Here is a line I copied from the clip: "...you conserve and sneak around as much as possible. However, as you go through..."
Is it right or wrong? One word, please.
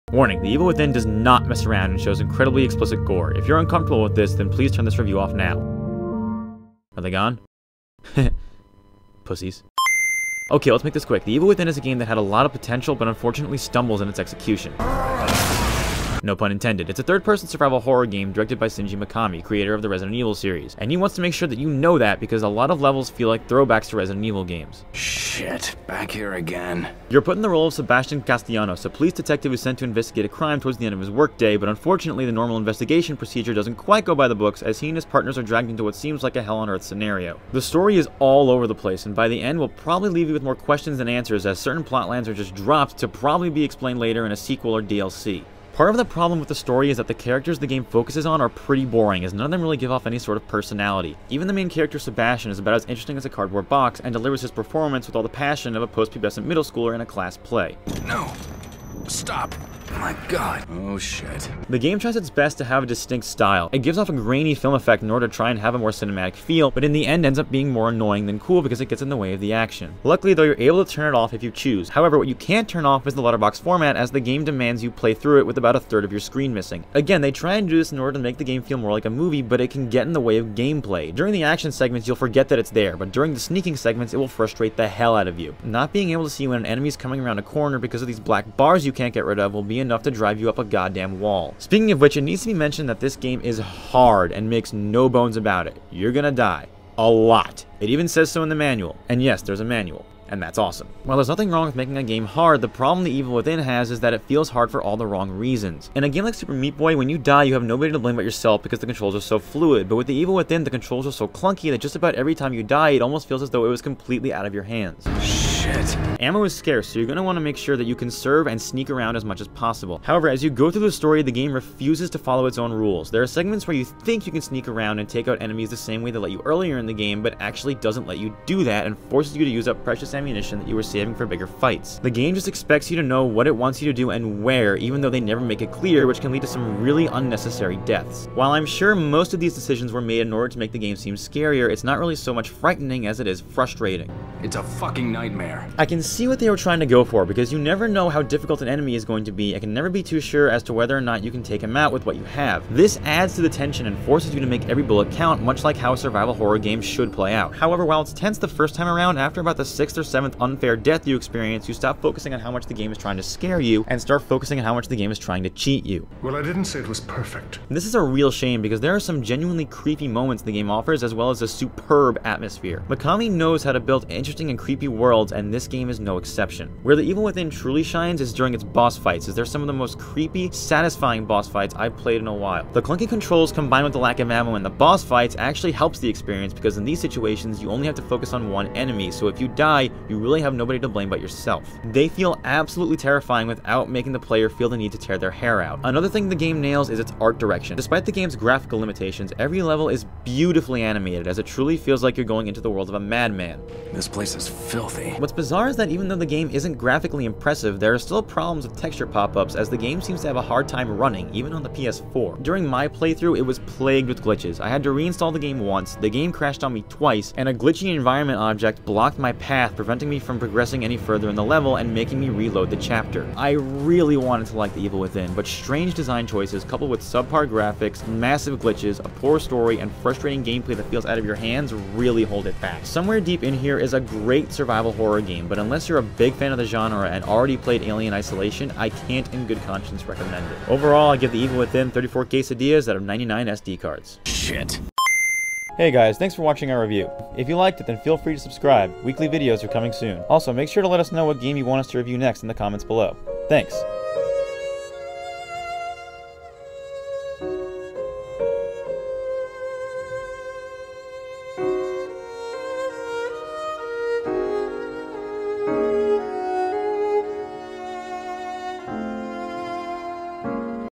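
right.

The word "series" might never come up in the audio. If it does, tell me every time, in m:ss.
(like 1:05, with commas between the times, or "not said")
0:20.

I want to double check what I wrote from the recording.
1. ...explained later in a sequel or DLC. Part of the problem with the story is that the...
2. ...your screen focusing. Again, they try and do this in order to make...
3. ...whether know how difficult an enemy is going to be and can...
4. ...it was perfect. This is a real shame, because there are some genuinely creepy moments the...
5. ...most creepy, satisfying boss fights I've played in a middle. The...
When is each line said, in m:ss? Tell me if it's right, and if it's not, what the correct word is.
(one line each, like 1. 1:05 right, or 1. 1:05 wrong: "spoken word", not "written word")
1. 0:43 right
2. 1:16 wrong: "missing", not "focusing"
3. 2:27 wrong: "never", not "whether"
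4. 2:46 right
5. 2:59 wrong: "while", not "middle".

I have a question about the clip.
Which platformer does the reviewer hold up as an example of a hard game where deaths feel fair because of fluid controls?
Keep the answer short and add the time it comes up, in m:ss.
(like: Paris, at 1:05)
Super Meat Boy, at 1:46.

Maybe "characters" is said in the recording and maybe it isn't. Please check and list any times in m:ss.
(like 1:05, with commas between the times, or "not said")
0:47, 0:51.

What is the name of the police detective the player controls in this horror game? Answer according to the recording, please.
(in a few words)
Sebastian Castellanos.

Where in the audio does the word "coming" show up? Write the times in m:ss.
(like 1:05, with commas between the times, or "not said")
1:26, 4:09.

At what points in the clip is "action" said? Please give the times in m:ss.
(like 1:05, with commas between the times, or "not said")
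1:09, 1:21.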